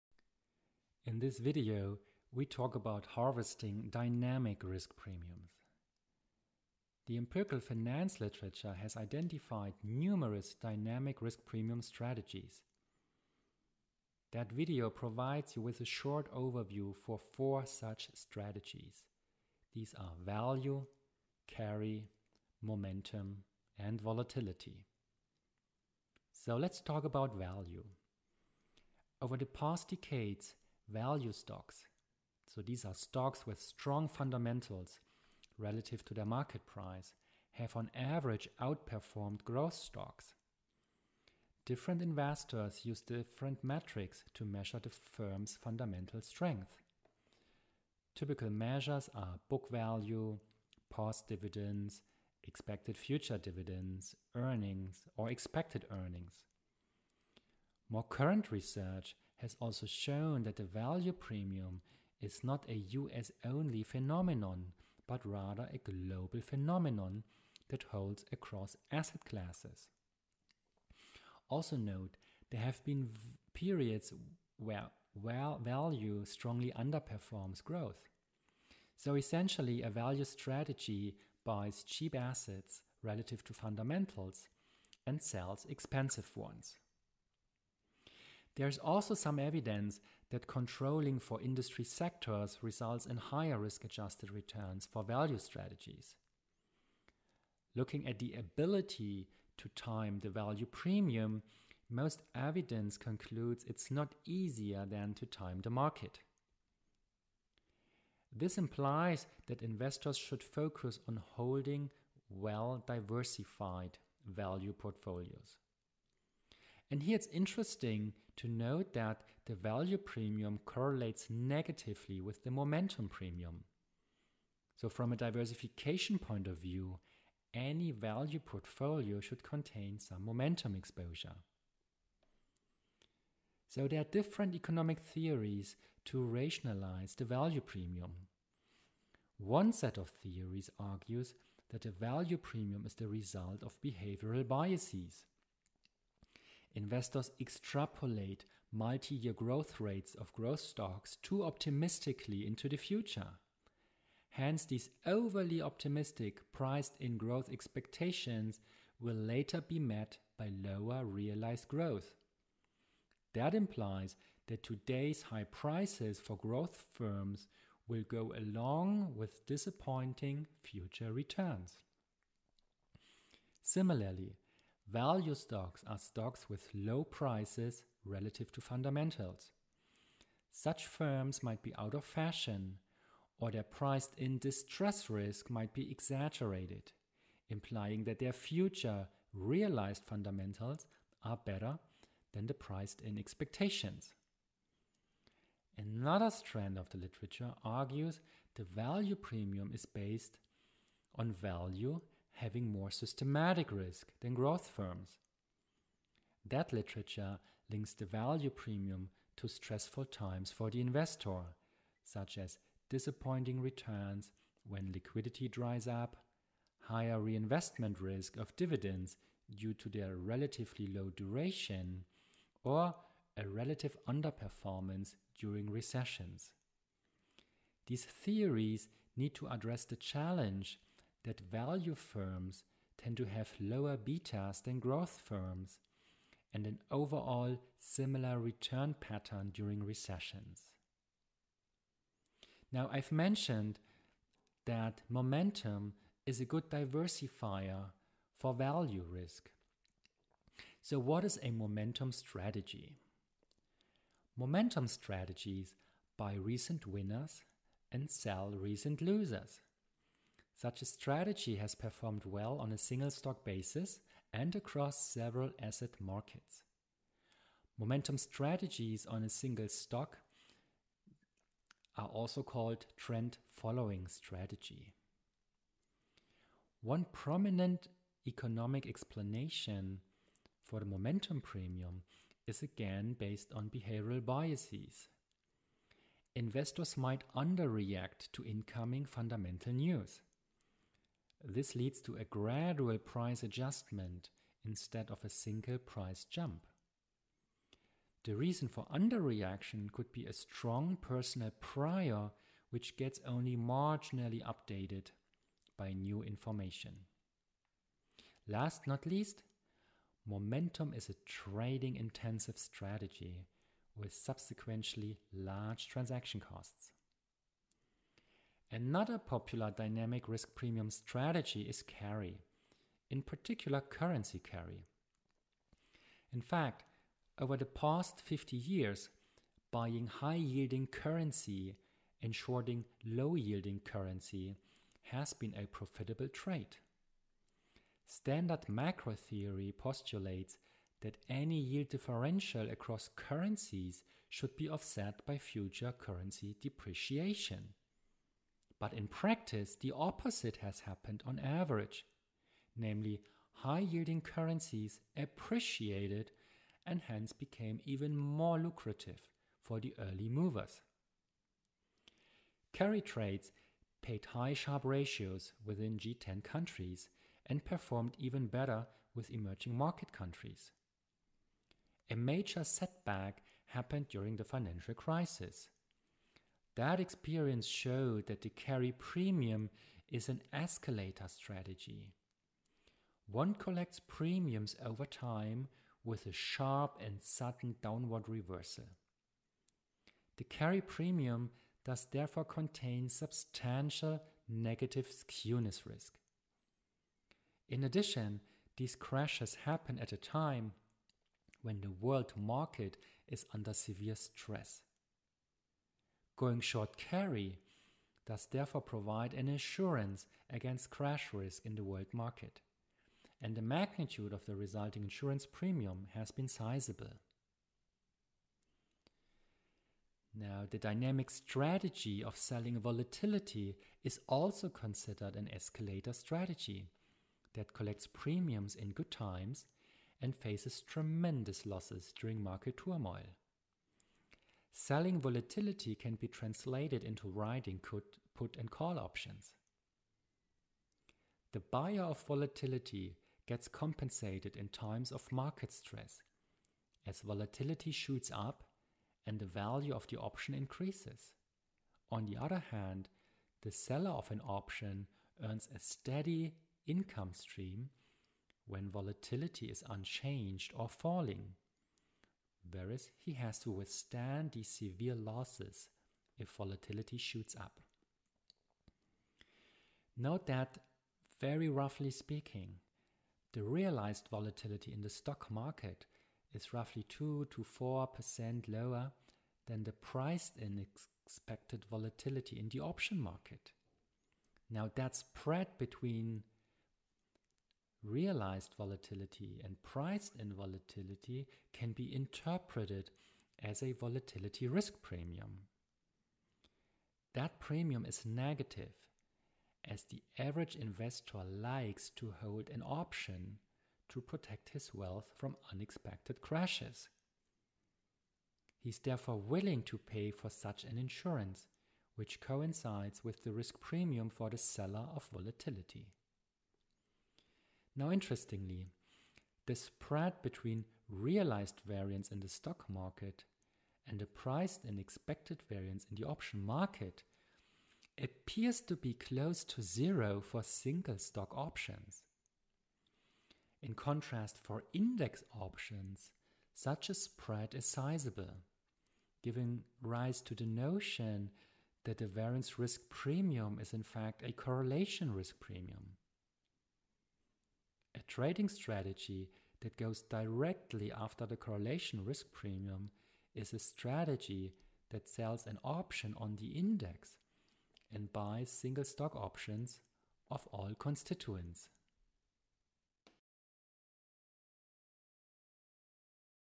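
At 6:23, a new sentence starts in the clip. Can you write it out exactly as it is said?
One collects premiums over time with a sharp and sudden downward reversal.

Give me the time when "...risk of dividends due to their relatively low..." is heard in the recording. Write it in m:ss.
3:37.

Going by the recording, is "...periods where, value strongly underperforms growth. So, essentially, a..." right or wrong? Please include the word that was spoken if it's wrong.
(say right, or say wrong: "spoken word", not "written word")
right.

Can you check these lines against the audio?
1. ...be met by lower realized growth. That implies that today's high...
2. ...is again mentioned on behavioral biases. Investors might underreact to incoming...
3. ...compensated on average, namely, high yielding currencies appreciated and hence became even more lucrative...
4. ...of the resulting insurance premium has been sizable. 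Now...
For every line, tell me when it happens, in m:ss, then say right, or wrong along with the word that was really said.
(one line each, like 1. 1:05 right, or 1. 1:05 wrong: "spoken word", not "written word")
1. 2:39 right
2. 4:42 wrong: "based", not "mentioned"
3. 5:50 wrong: "happened", not "compensated"
4. 6:54 right.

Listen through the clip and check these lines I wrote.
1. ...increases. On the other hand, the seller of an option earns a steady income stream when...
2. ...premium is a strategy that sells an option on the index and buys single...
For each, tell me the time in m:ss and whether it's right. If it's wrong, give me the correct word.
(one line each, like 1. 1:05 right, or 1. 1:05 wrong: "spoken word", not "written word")
1. 7:30 right
2. 9:12 right.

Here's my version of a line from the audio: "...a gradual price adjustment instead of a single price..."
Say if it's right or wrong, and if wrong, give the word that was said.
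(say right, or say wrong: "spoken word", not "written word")
right.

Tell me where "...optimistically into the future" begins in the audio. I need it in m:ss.
2:31.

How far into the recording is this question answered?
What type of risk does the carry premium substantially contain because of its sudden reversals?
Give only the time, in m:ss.
6:34.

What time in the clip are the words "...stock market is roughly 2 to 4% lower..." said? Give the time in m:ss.
7:55.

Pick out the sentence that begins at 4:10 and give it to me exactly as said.
So, what is a momentum strategy?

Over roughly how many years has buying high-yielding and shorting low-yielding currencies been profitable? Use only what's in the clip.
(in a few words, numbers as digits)
50.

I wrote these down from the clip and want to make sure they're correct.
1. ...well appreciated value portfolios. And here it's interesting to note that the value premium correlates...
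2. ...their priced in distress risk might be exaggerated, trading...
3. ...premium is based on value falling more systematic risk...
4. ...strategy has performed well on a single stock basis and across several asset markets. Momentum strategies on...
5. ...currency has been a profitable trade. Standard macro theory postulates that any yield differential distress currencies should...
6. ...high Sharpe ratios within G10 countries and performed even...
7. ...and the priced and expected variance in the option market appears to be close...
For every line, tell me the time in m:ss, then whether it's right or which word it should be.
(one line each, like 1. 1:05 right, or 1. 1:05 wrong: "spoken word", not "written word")
1. 1:52 wrong: "diversified", not "appreciated"
2. 3:03 wrong: "implying", not "trading"
3. 3:19 wrong: "having", not "falling"
4. 4:20 right
5. 5:33 wrong: "across", not "distress"
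6. 6:04 right
7. 8:44 right.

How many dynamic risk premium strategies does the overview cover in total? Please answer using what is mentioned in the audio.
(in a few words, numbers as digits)
4.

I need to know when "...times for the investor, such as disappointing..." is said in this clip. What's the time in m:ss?
3:30.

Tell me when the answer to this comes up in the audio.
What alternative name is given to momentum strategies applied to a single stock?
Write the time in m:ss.
4:32.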